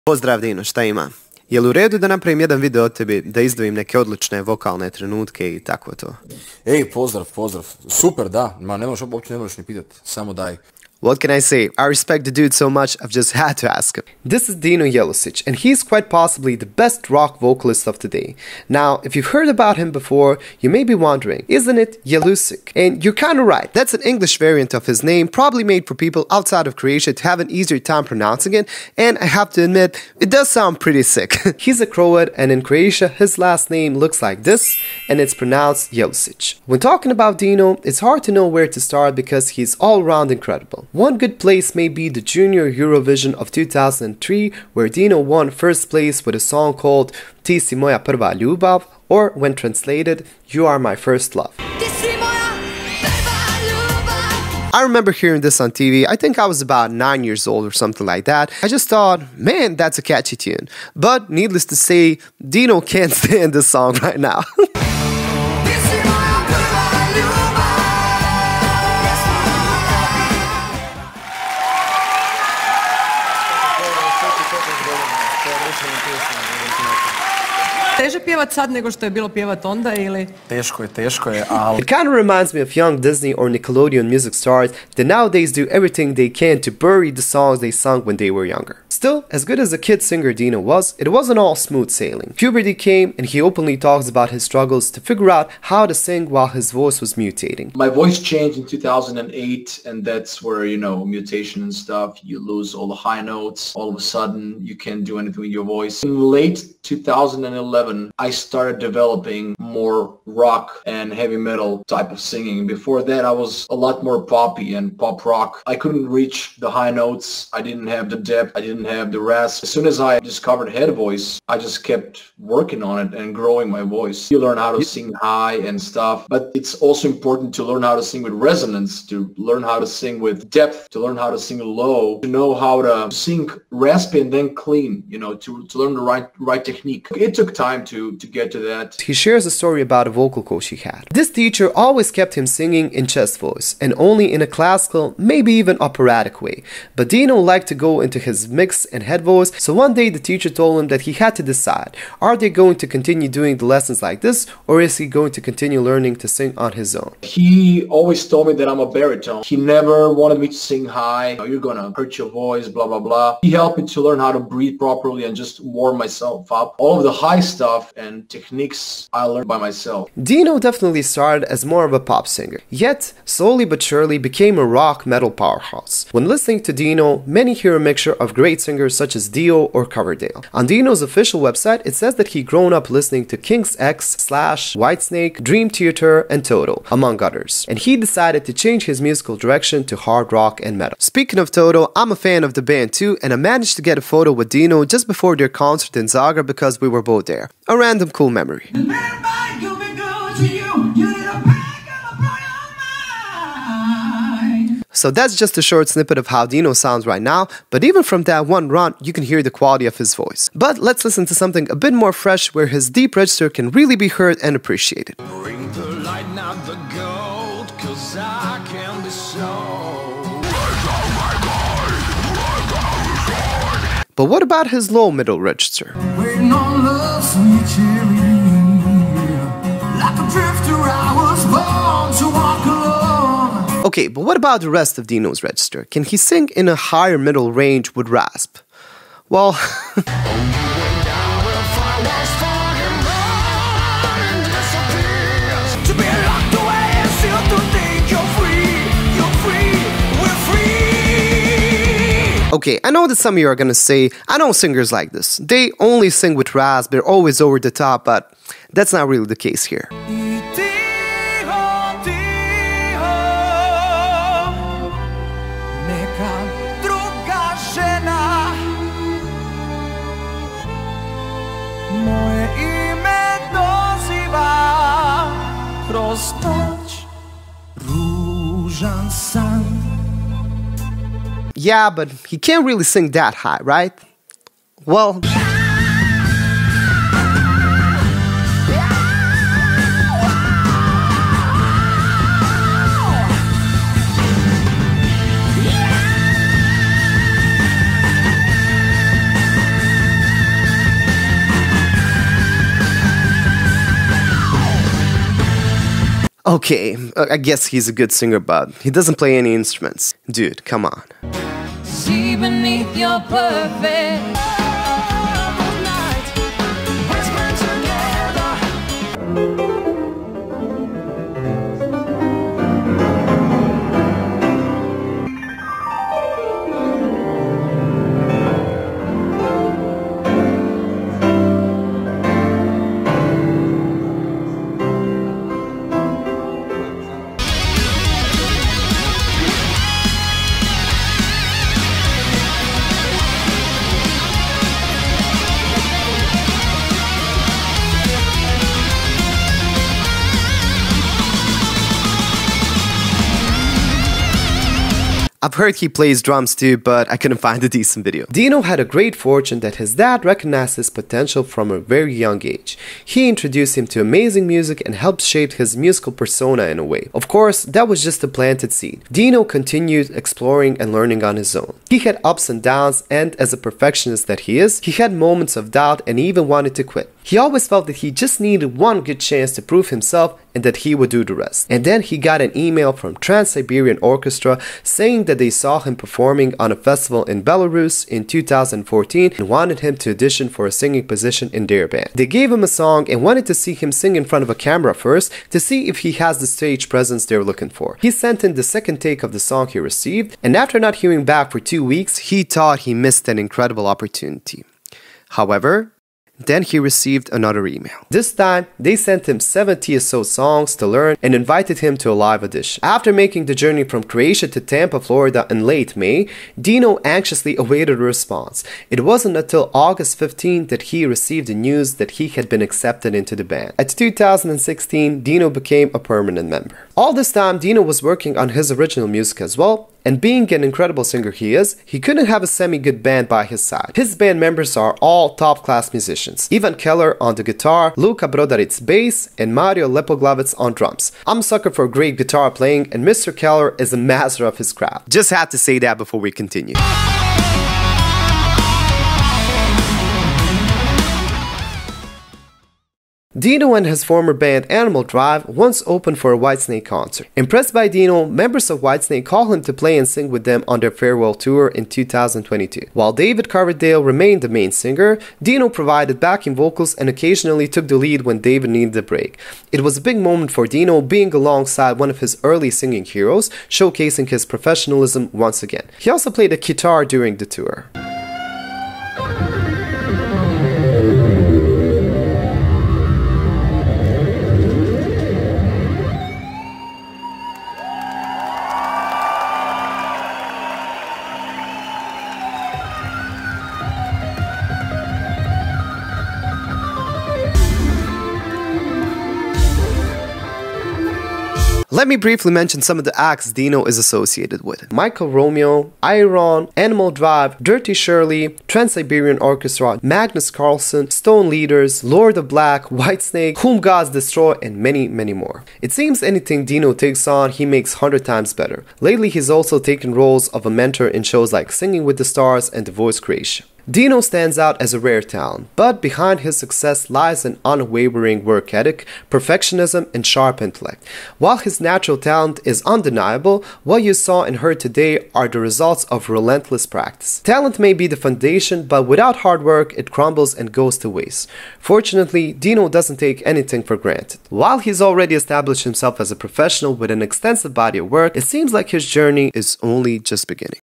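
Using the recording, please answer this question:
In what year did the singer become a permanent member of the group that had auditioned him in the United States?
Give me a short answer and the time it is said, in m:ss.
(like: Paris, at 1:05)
2016, at 7:03.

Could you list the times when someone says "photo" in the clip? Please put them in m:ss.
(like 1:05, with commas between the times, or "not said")
3:14.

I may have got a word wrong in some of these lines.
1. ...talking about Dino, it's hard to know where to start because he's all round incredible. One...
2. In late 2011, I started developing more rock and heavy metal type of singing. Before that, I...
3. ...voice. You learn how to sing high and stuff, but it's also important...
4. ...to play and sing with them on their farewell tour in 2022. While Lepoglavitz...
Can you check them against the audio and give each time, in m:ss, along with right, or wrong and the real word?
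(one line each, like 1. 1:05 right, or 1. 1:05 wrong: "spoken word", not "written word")
1. 0:36 right
2. 1:46 right
3. 2:03 right
4. 7:39 wrong: "David", not "Lepoglavitz".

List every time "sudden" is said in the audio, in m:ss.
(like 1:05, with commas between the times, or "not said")
1:43.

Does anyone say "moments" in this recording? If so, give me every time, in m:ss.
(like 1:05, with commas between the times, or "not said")
6:15, 7:50.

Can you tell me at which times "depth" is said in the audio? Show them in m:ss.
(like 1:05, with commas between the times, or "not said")
1:58, 2:10.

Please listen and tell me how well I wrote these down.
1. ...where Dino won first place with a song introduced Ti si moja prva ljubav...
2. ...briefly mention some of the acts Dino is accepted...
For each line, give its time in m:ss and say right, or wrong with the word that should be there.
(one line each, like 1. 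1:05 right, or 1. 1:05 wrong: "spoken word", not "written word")
1. 0:44 wrong: "called", not "introduced"
2. 8:22 wrong: "associated", not "accepted".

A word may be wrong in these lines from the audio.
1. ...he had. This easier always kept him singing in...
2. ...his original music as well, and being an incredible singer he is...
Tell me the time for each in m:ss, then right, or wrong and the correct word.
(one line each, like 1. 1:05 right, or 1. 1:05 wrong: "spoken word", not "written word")
1. 2:20 wrong: "teacher", not "easier"
2. 7:08 right.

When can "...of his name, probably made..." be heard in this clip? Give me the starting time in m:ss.
0:24.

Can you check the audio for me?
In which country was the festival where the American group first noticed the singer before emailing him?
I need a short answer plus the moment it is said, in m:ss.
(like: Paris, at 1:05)
Belarus, at 6:27.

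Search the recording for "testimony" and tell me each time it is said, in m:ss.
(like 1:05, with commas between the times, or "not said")
not said.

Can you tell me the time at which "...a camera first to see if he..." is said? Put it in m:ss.
6:34.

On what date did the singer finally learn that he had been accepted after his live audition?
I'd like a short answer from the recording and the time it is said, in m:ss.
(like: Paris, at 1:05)
August 15, at 6:59.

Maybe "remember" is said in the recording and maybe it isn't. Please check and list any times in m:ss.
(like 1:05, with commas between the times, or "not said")
0:54.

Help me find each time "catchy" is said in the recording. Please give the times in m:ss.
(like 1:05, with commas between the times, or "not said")
1:00.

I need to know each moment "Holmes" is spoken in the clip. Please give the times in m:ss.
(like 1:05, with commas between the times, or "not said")
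not said.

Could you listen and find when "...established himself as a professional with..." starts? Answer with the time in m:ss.
9:05.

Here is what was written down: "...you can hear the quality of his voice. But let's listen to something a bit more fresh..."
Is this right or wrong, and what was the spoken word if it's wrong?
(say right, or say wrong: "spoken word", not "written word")
right.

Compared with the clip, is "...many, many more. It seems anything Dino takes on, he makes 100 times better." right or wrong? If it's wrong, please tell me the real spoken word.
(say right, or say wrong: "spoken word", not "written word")
right.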